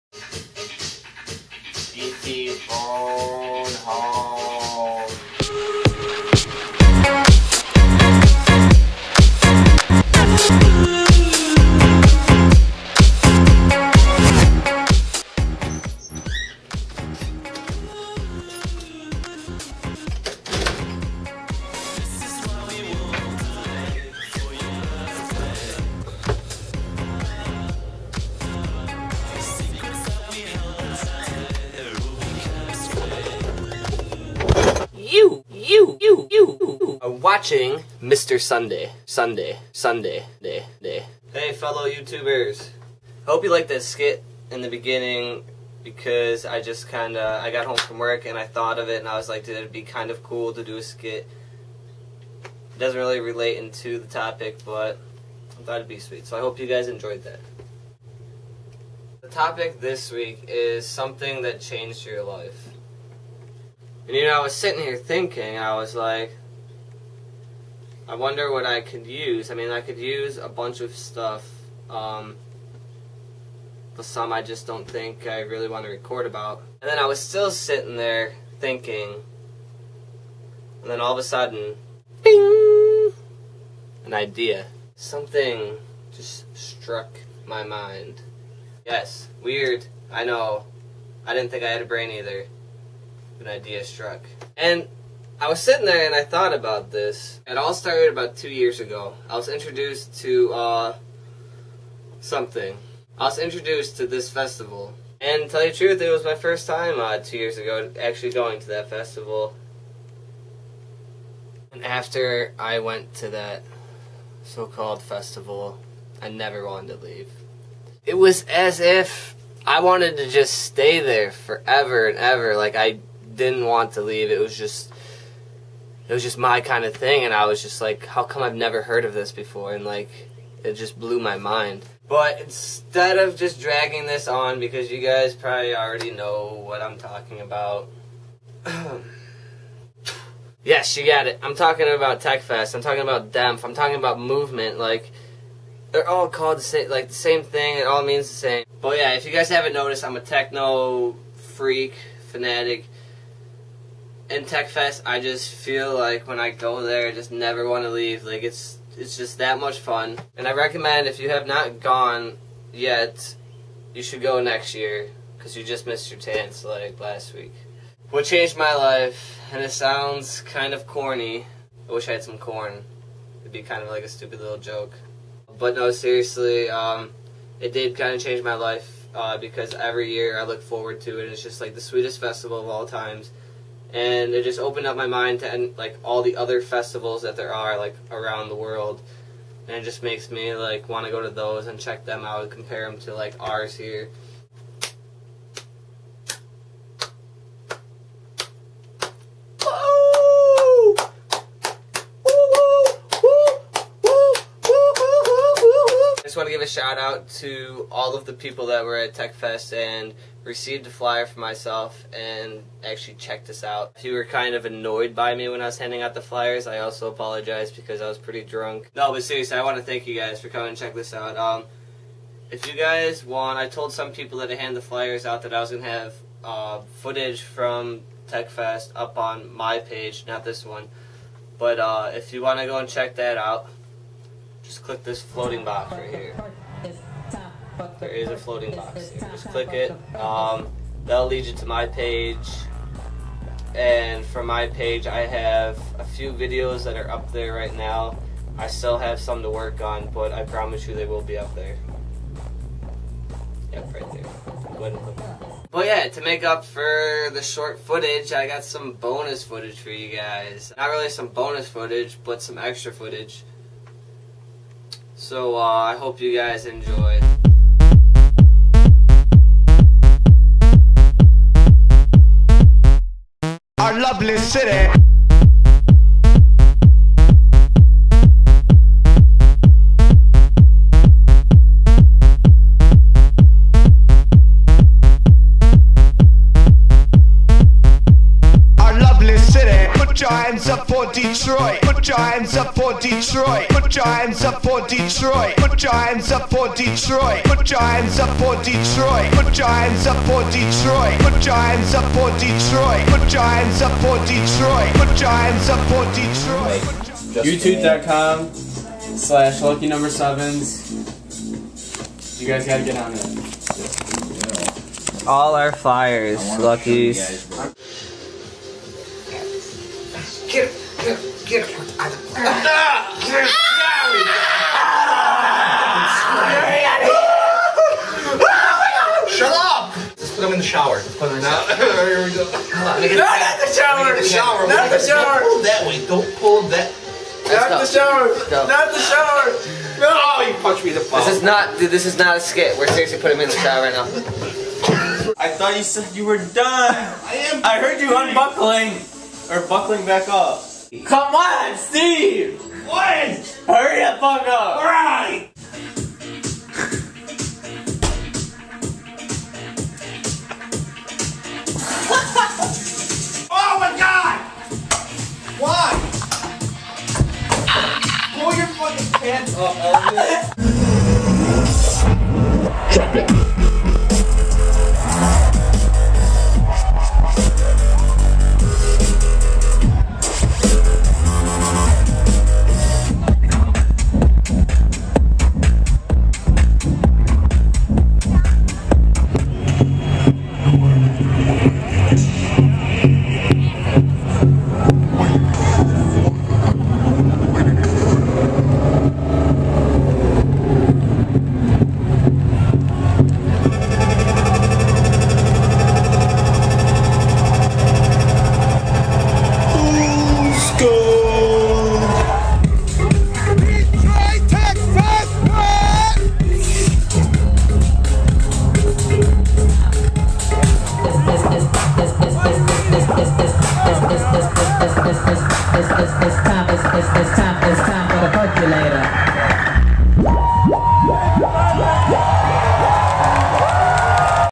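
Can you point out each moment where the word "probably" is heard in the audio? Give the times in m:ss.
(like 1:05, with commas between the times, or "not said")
2:15.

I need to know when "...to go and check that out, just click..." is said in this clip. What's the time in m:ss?
3:52.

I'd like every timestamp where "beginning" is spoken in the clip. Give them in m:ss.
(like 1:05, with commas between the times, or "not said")
0:44.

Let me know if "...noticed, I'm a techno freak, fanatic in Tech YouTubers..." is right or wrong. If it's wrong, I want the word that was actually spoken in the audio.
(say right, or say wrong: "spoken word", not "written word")
wrong: "Fest", not "YouTubers".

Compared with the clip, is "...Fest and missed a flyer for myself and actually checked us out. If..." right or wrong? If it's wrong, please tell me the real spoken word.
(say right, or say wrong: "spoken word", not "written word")
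wrong: "received", not "missed".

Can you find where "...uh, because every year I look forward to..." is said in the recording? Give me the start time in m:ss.
2:59.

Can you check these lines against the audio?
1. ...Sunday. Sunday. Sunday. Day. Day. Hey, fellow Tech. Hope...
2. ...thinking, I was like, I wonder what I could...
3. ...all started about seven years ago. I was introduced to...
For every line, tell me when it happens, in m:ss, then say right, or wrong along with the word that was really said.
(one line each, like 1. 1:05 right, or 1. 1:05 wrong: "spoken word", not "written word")
1. 0:38 wrong: "YouTubers", not "Tech"
2. 1:04 right
3. 1:37 wrong: "two", not "seven".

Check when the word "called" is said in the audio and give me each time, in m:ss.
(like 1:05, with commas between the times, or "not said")
1:54, 2:26.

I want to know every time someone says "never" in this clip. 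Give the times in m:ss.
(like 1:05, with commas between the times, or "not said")
1:56, 2:08, 2:37.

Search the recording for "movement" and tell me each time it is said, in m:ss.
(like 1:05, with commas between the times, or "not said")
2:24.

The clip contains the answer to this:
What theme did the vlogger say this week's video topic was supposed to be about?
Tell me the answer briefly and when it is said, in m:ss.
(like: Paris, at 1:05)
Something that changed your life, at 1:00.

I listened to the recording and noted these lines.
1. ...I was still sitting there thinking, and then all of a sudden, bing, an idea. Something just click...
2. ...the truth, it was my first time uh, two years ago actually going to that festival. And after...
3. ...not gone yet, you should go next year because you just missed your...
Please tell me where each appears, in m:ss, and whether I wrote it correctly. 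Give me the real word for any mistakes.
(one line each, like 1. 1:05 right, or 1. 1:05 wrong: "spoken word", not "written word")
1. 1:16 wrong: "struck", not "click"
2. 1:45 right
3. 2:41 right.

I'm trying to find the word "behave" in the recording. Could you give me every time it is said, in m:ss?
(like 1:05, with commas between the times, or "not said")
not said.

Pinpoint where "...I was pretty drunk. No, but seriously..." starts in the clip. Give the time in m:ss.
3:38.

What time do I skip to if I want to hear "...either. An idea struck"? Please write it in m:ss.
1:32.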